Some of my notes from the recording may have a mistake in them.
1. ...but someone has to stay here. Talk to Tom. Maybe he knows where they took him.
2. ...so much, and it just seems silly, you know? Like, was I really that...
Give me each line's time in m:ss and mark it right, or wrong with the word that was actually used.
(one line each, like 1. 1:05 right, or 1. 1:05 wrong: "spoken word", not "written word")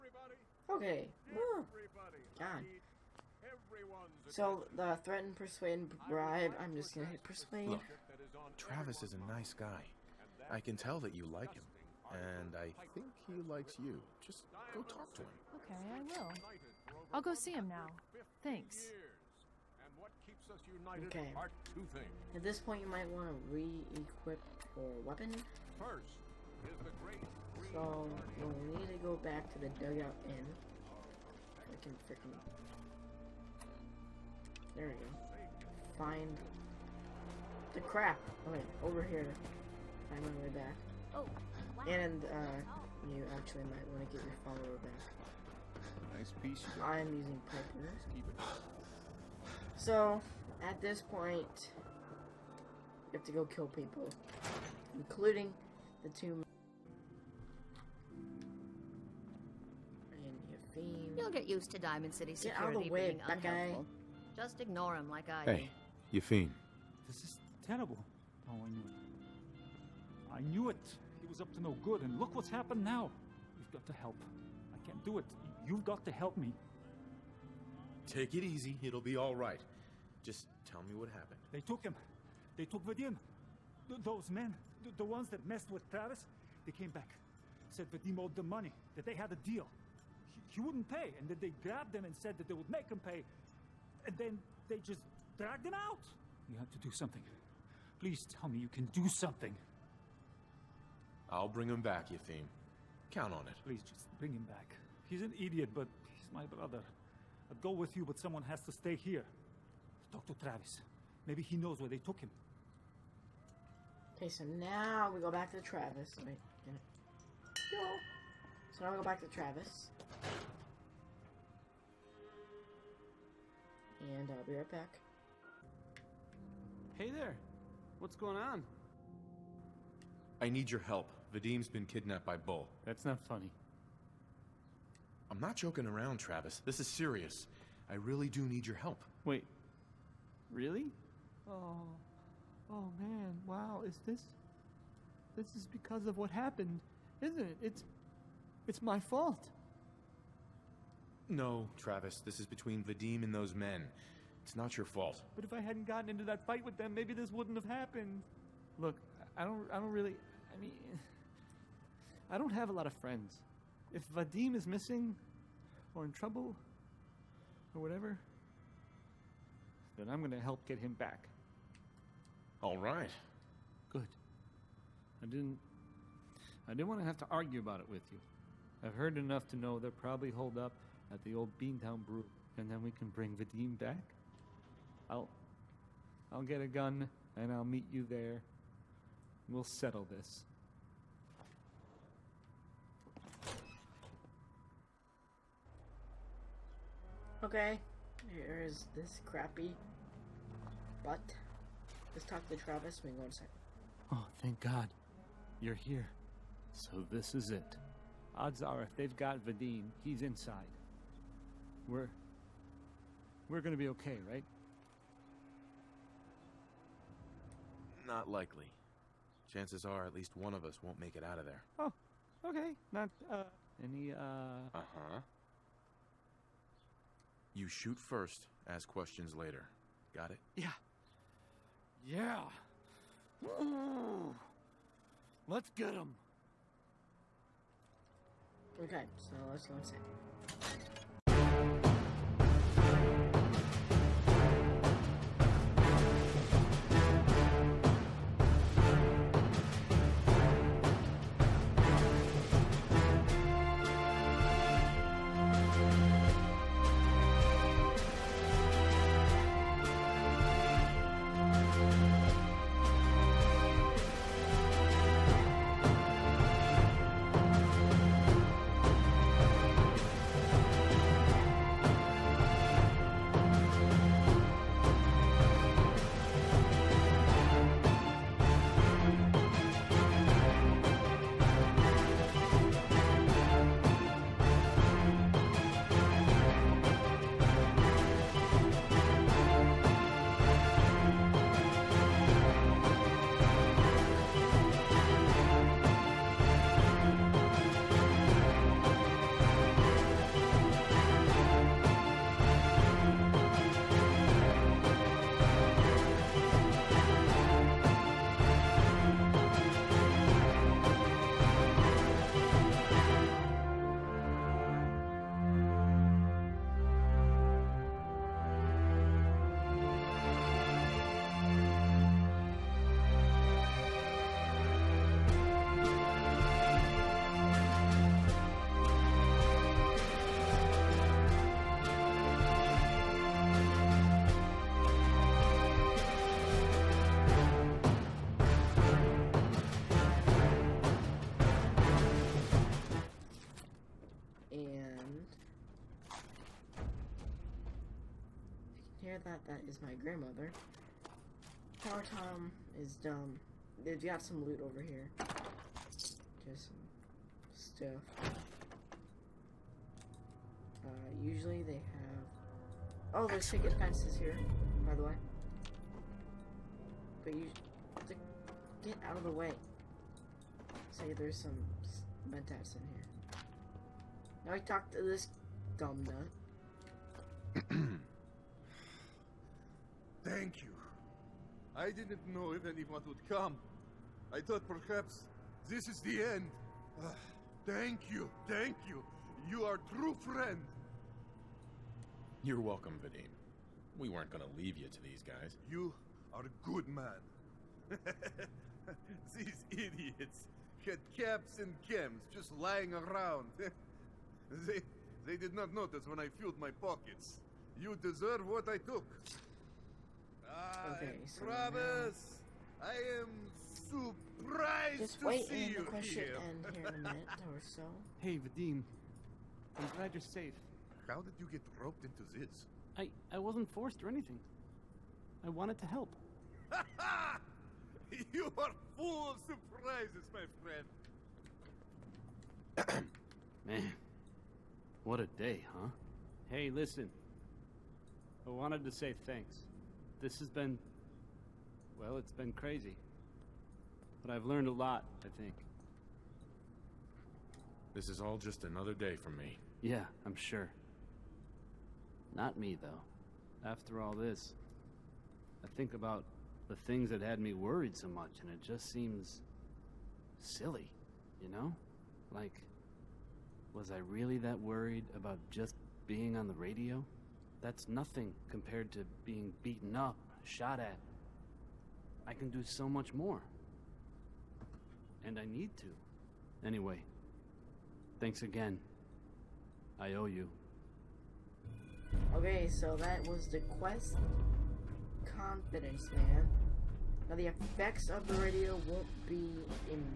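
1. 1:48 wrong: "Travis", not "Tom"
2. 7:37 right.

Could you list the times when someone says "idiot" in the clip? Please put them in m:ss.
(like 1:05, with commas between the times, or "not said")
1:45, 6:39.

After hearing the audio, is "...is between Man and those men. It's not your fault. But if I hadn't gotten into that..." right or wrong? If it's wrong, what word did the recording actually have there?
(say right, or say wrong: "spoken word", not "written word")
wrong: "Vadim", not "Man".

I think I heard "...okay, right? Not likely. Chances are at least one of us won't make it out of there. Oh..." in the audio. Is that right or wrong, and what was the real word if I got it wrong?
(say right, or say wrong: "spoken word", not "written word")
right.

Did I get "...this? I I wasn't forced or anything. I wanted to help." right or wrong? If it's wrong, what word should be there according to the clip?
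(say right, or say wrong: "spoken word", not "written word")
right.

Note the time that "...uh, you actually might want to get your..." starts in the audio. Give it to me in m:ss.
0:42.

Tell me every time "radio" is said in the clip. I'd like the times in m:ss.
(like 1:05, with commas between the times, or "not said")
7:46, 8:08.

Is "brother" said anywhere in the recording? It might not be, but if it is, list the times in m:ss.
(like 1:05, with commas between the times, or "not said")
1:46, 6:51.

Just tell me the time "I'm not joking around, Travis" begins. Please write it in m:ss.
2:15.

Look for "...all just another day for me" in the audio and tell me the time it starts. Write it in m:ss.
7:28.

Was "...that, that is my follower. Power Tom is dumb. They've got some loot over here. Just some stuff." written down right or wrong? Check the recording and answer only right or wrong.
wrong.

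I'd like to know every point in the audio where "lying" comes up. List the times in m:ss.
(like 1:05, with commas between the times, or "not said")
6:42.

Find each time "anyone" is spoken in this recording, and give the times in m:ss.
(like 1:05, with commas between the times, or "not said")
6:22.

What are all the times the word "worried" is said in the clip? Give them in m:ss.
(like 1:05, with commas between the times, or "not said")
7:37, 7:44.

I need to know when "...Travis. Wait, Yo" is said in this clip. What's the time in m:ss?
1:55.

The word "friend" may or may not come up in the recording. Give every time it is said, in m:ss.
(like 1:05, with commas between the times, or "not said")
2:42, 6:30, 7:12.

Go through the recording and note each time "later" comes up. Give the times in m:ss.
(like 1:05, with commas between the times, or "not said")
3:49.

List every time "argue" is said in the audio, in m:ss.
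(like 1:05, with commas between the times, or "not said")
2:57.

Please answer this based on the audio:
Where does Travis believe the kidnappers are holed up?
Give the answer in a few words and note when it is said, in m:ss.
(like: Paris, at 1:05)
Beantown Brew, at 3:01.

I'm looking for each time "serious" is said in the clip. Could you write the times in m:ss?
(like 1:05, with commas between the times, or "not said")
2:16.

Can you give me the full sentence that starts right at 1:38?
Please tell me you can do something.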